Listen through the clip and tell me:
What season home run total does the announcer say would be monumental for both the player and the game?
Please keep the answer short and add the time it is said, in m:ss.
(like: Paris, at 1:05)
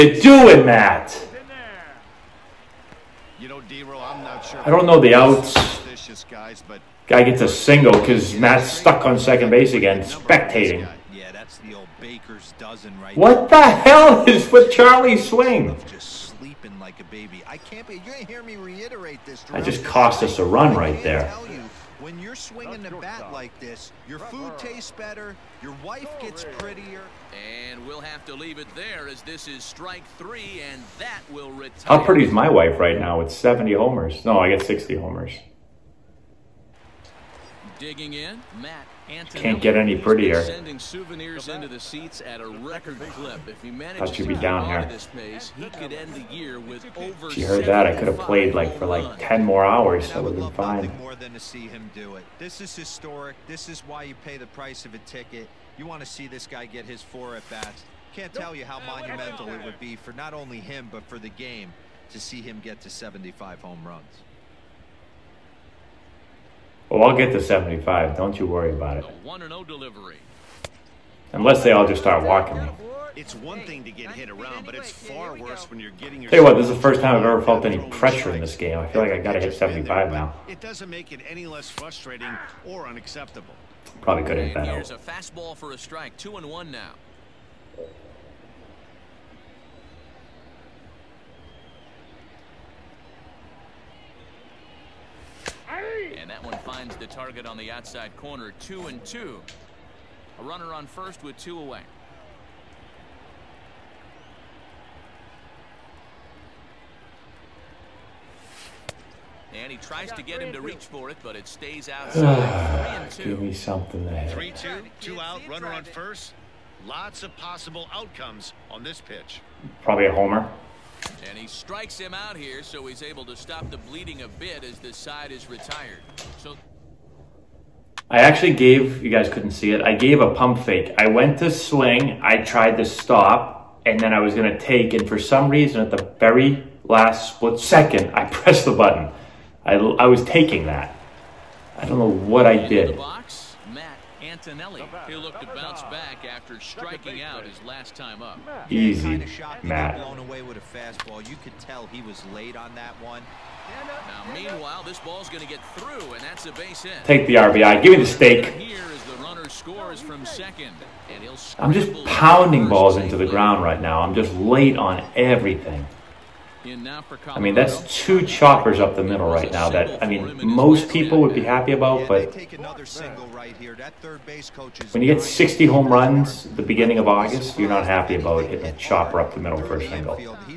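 75, at 1:02.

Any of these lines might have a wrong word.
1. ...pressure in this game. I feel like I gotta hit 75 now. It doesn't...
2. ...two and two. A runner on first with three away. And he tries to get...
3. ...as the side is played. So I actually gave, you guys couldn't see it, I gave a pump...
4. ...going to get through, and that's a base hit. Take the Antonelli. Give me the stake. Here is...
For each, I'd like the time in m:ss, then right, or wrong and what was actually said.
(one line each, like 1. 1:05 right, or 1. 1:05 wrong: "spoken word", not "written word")
1. 1:17 right
2. 1:38 wrong: "two", not "three"
3. 2:04 wrong: "retired", not "played"
4. 2:35 wrong: "RBI", not "Antonelli".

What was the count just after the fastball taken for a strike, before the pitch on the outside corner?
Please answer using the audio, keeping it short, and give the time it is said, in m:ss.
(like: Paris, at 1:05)
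2 and 1, at 1:26.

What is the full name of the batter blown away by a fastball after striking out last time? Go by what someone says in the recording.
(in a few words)
Matt Antonelli.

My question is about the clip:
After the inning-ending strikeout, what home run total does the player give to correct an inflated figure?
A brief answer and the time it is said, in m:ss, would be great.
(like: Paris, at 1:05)
60, at 0:34.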